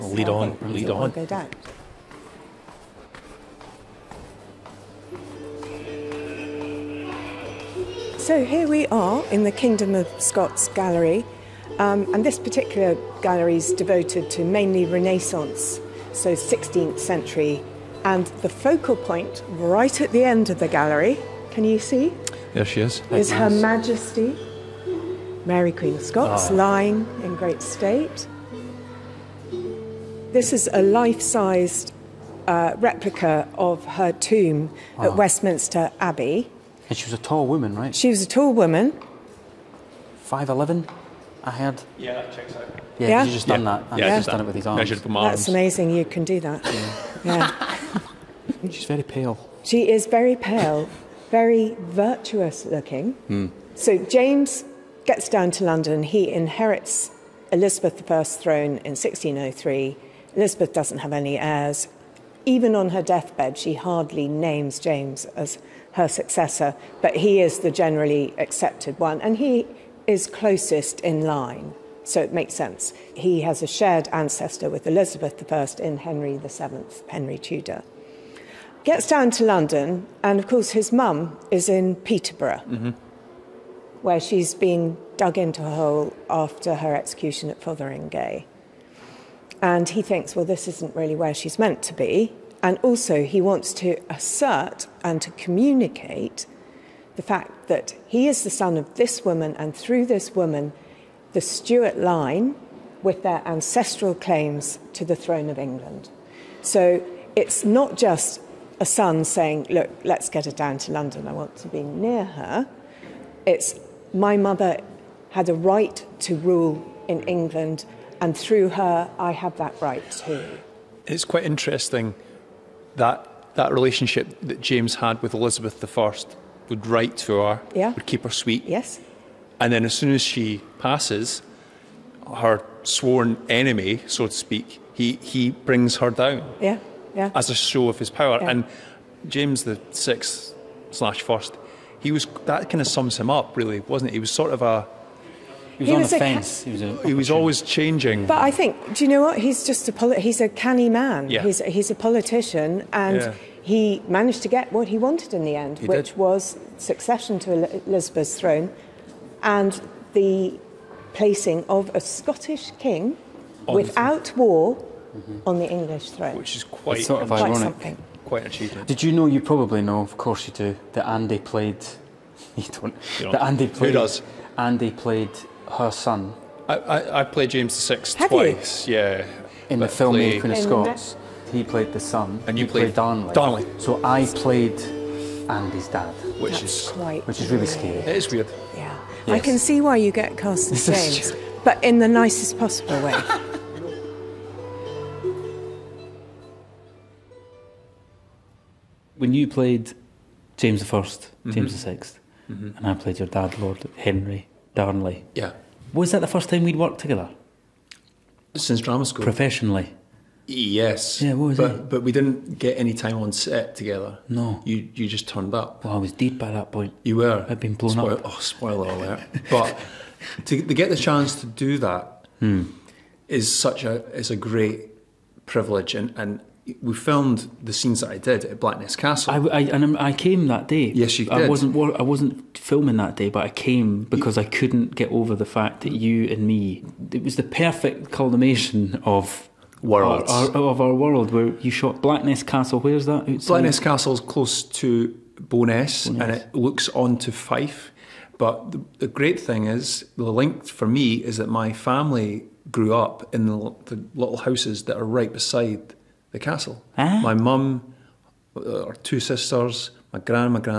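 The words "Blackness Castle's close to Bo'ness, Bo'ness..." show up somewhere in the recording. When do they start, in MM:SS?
04:03.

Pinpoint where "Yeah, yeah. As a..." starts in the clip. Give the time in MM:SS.
02:16.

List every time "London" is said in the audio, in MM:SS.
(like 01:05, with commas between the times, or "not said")
00:55, 01:19, 01:50.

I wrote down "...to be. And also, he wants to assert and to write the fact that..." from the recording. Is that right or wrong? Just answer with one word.
wrong.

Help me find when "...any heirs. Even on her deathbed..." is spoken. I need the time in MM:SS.
01:01.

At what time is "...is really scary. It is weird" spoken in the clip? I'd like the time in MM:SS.
03:07.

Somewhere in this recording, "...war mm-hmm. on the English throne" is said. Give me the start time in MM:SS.
02:44.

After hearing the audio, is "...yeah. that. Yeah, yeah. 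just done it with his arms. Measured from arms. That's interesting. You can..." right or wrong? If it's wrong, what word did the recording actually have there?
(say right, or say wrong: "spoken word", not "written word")
wrong: "amazing", not "interesting".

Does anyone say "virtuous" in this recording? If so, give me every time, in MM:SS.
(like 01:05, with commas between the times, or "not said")
00:51.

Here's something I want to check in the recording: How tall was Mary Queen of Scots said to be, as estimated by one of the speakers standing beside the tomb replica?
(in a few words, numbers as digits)
5'11.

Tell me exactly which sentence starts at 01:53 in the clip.
It's my mother had a right to rule in England, and through her, I have that right too.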